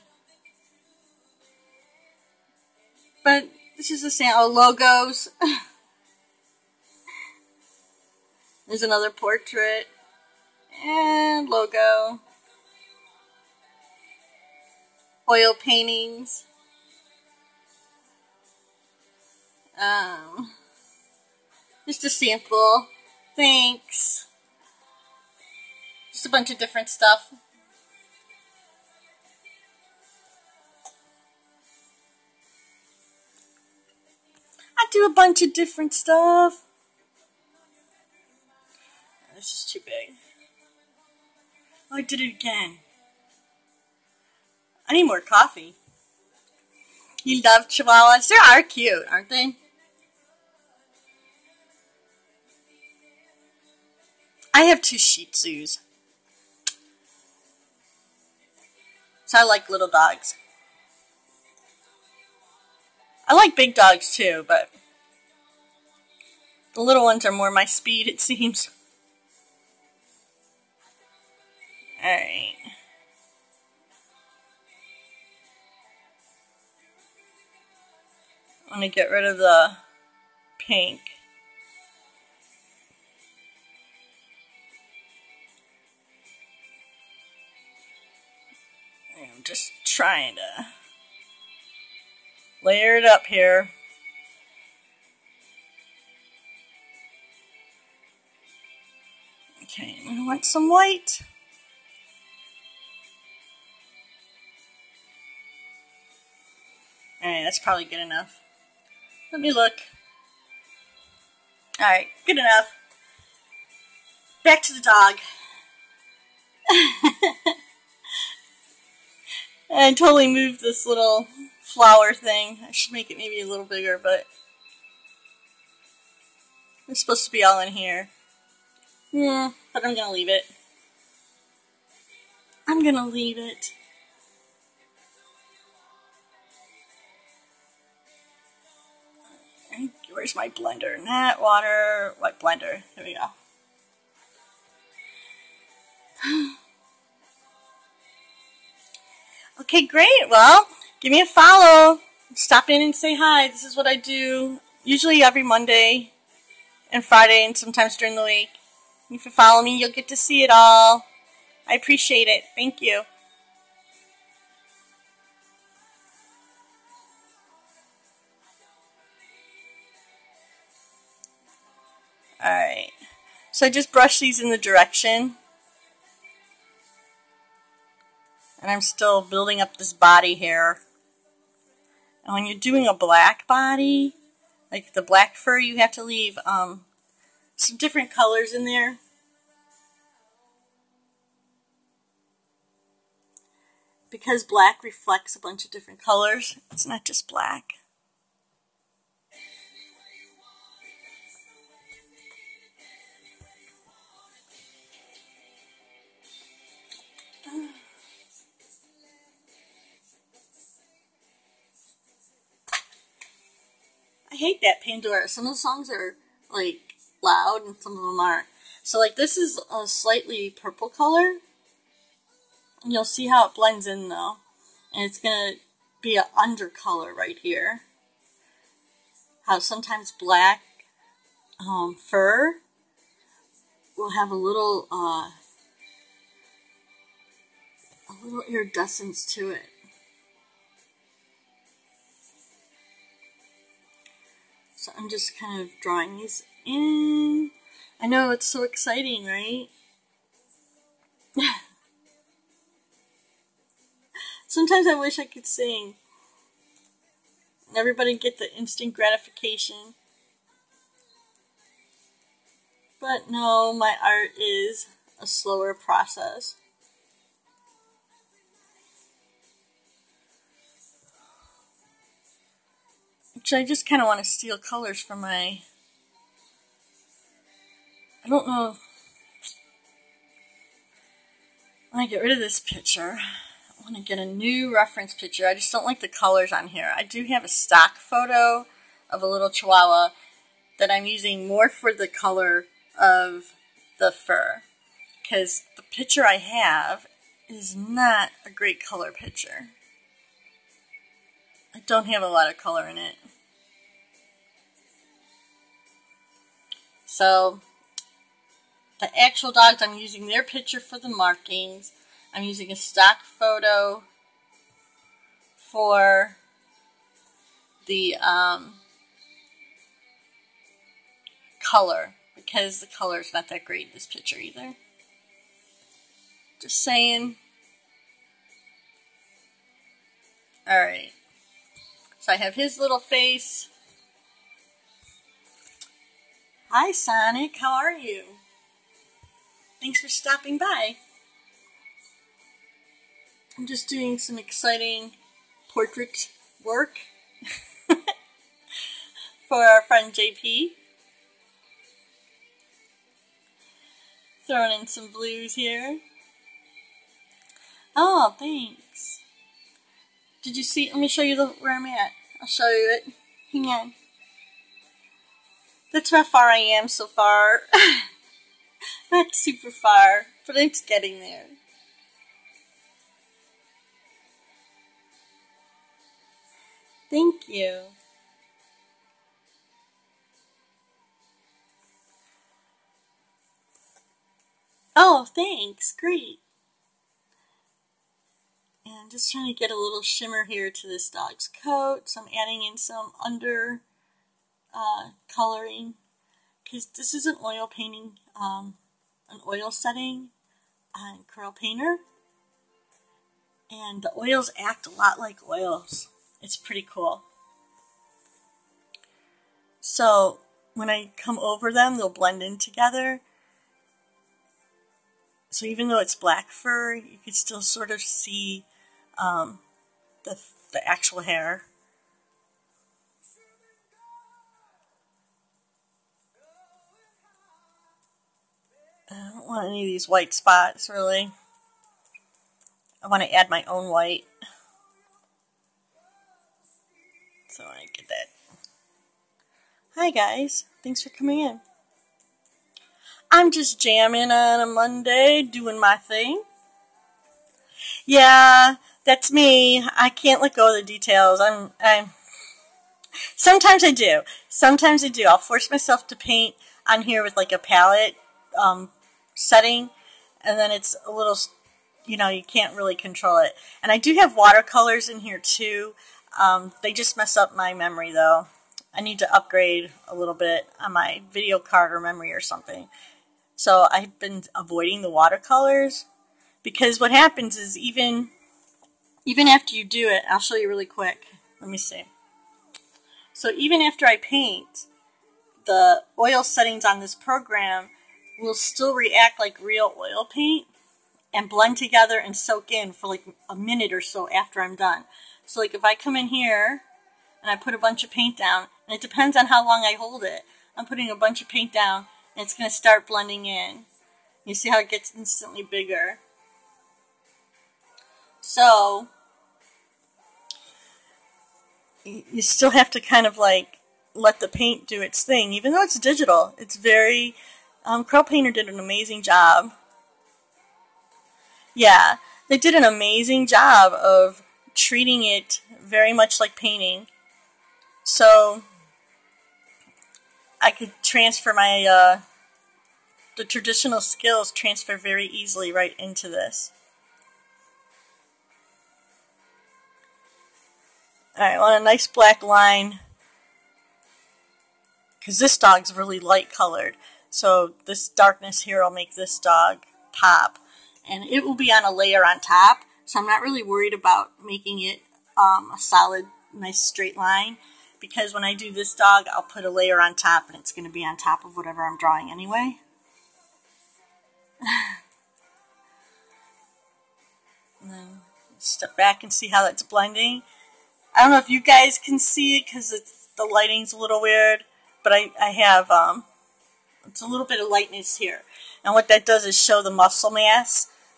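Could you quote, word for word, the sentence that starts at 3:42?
You'll see how it blends in though.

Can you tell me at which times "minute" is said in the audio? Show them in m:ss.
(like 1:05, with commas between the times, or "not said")
8:13.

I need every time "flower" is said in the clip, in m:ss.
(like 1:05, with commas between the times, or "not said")
2:01.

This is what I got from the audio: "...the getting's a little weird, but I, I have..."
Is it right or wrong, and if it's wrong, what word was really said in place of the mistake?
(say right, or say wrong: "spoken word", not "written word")
wrong: "lighting", not "getting".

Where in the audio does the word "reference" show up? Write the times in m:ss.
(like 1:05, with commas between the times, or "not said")
4:44.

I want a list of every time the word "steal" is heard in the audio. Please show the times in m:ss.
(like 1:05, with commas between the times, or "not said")
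4:34.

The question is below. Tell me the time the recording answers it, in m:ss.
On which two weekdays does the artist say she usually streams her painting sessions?
2:35.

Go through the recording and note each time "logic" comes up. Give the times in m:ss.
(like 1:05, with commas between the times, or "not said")
not said.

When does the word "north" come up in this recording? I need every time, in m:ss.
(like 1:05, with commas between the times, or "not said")
not said.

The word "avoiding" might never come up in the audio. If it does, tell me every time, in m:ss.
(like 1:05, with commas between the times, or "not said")
7:54.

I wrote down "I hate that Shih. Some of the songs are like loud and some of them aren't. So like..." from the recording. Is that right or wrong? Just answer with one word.
wrong.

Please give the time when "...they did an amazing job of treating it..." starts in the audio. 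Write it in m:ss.
8:42.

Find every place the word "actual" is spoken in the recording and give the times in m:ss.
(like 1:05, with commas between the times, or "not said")
5:09, 7:00.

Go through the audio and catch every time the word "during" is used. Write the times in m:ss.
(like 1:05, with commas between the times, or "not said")
2:37.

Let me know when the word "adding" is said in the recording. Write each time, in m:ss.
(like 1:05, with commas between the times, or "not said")
6:32.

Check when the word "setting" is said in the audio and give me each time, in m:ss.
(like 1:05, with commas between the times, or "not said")
6:39, 7:39, 8:06.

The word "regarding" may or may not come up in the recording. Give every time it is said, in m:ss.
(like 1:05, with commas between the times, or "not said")
not said.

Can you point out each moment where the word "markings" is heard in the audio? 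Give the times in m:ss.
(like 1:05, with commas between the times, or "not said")
5:11.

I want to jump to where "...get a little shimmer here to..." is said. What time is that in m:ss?
6:29.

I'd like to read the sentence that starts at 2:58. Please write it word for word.
And I'm still building up this body hair.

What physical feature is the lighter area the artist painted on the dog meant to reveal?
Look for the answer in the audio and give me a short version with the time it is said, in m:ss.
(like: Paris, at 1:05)
muscle mass, at 9:39.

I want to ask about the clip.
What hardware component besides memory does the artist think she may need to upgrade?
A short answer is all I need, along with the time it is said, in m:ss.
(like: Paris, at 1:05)
video card, at 7:51.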